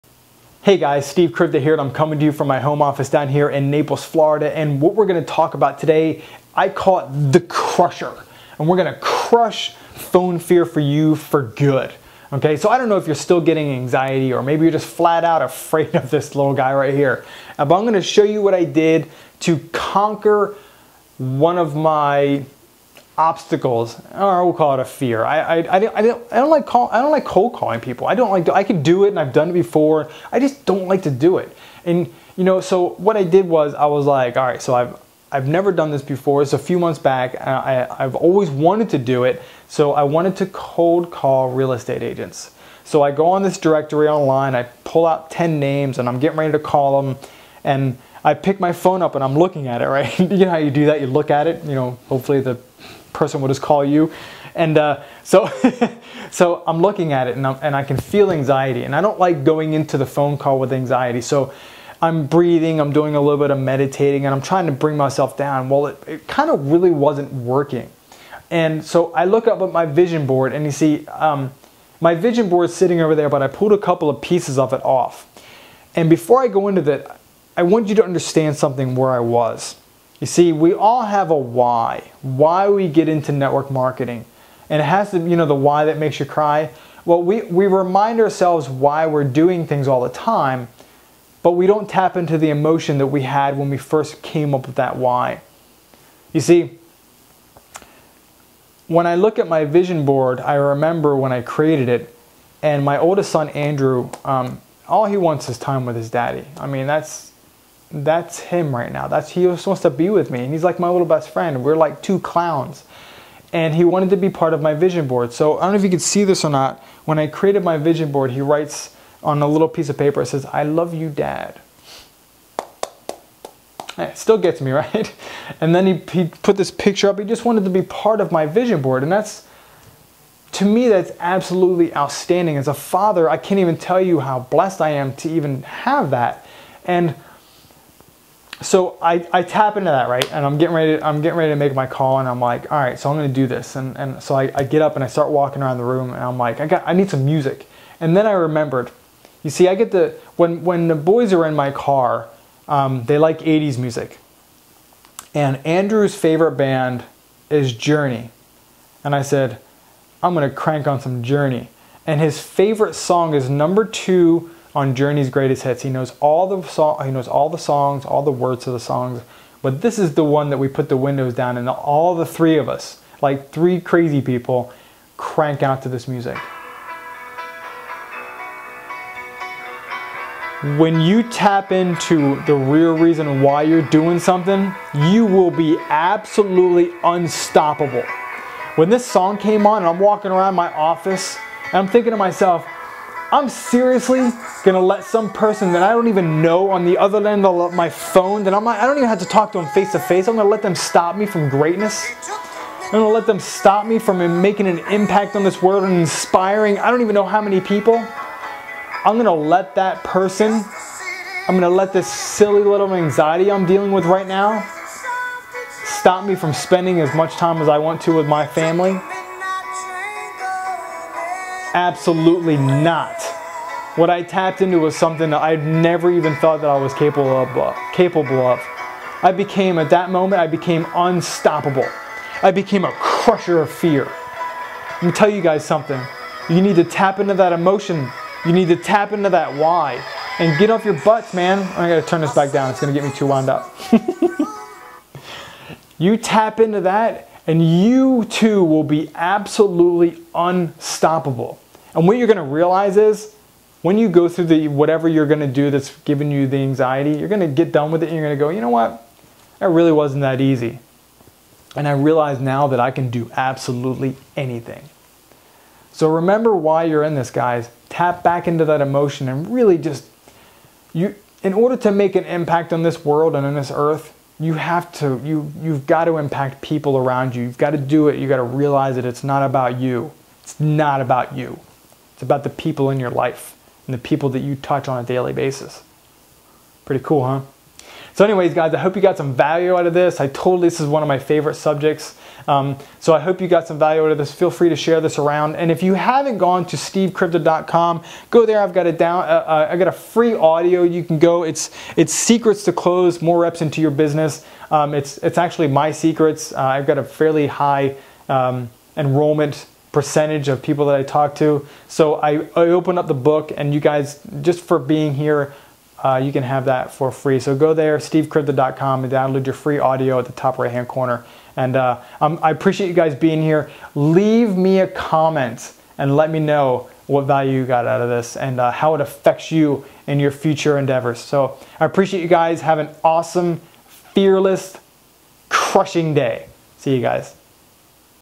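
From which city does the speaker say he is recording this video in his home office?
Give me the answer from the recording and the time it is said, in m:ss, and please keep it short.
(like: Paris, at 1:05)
Naples, at 0:03.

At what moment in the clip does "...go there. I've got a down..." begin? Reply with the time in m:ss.
4:58.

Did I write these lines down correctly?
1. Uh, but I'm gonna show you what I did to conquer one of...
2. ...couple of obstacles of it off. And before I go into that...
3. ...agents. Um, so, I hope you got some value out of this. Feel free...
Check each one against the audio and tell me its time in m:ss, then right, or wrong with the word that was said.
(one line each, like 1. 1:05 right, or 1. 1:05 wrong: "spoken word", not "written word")
1. 0:17 right
2. 1:13 wrong: "pieces", not "obstacles"
3. 4:51 wrong: "subjects", not "agents".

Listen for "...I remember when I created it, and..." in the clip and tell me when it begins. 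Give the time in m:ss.
1:40.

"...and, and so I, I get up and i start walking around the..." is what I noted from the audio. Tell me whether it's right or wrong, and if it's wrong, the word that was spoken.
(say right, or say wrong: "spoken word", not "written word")
right.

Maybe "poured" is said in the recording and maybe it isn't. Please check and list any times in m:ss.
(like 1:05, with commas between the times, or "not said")
not said.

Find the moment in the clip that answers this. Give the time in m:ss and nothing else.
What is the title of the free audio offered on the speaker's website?
5:02.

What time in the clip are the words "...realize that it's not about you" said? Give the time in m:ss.
4:38.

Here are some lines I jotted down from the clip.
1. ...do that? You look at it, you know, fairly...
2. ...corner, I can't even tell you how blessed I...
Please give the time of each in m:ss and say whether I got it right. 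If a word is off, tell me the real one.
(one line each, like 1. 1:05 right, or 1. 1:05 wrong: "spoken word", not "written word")
1. 0:50 wrong: "hopefully", not "fairly"
2. 2:12 wrong: "father", not "corner".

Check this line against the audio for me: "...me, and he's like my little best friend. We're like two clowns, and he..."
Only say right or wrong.
right.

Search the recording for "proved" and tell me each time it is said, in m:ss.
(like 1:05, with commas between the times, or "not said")
not said.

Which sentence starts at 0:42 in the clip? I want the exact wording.
So I go on this directory online.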